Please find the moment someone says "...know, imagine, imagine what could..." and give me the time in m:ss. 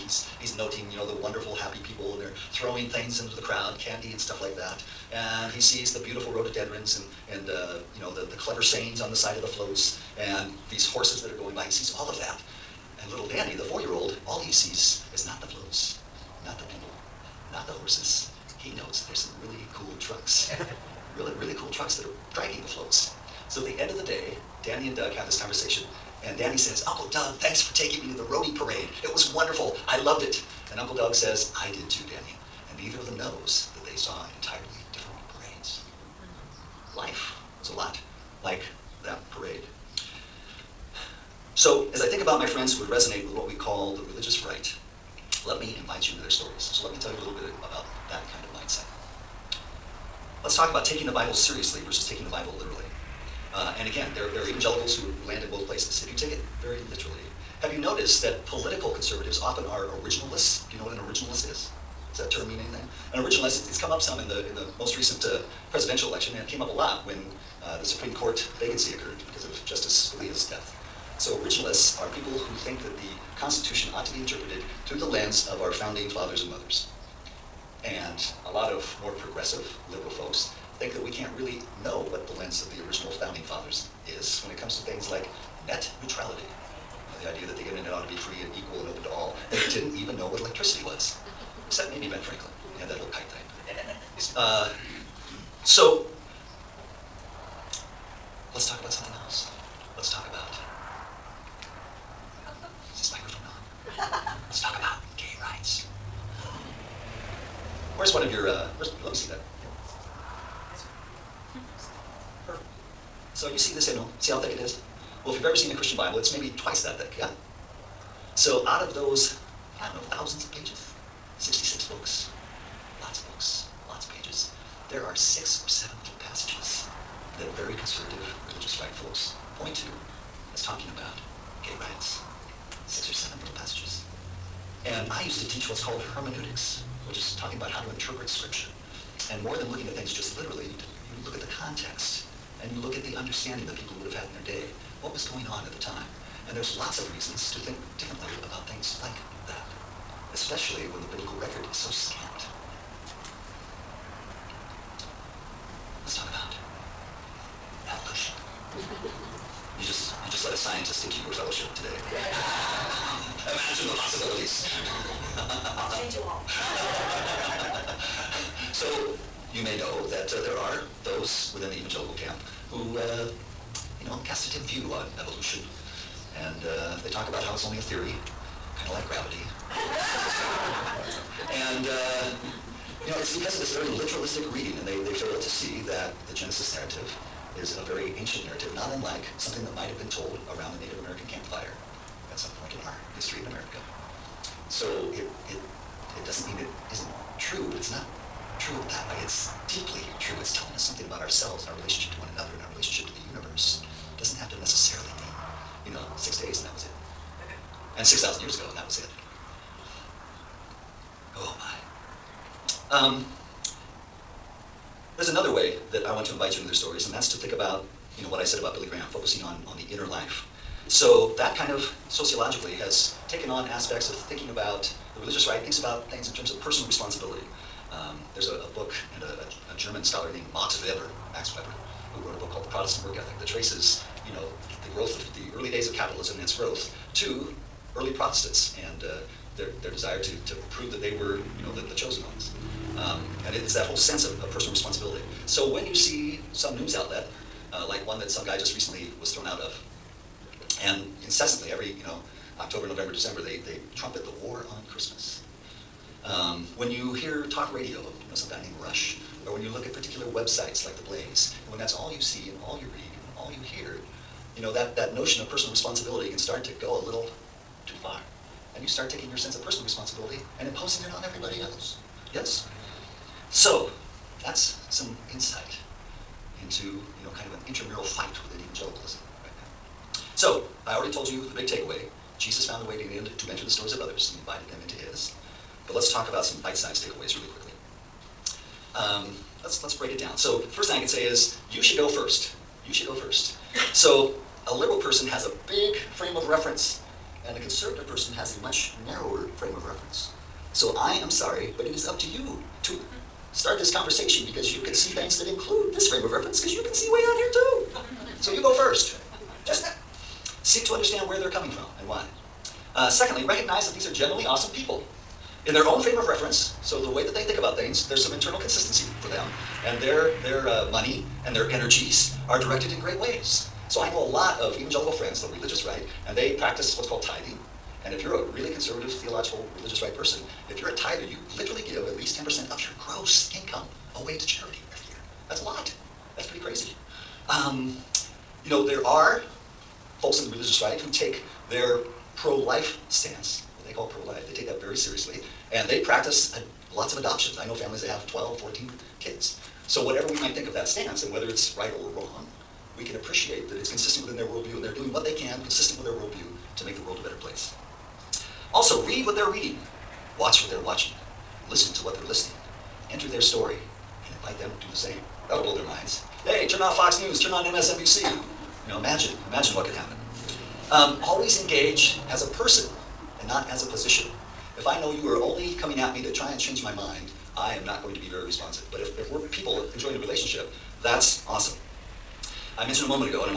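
6:08.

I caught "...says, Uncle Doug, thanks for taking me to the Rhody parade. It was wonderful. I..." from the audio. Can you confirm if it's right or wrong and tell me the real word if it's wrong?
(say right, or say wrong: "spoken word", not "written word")
right.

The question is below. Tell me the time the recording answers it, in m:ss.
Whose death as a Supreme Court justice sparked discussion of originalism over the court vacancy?
1:09.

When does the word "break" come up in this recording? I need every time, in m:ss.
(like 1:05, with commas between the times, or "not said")
4:49.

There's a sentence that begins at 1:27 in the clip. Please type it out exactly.
You uh, know, the idea that the internet ought to be free and equal and open to all.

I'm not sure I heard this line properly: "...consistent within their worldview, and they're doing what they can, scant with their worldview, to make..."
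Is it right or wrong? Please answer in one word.
wrong.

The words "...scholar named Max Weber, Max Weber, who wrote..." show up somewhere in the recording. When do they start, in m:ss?
3:50.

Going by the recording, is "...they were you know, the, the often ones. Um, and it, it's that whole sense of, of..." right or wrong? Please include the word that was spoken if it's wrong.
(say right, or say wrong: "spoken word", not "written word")
wrong: "chosen", not "often".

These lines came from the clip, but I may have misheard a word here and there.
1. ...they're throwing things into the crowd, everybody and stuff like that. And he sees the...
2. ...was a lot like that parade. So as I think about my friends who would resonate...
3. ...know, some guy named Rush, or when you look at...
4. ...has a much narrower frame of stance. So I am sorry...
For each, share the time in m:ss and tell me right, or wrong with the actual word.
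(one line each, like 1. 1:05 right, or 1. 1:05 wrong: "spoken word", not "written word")
1. 0:02 wrong: "candy", not "everybody"
2. 0:37 right
3. 4:18 right
4. 4:58 wrong: "reference", not "stance".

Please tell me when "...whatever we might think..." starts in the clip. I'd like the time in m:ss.
5:50.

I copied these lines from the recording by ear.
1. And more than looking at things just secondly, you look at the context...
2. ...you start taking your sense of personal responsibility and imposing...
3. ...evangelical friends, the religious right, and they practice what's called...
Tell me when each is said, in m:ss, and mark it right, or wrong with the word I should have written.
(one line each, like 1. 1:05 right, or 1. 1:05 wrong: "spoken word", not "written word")
1. 2:19 wrong: "literally", not "secondly"
2. 4:28 right
3. 5:24 right.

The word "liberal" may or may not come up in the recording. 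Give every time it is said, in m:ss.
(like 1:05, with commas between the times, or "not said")
1:19, 4:54.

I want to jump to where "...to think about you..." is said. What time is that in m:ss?
3:37.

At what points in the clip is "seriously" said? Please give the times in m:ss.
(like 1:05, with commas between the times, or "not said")
0:51, 5:44.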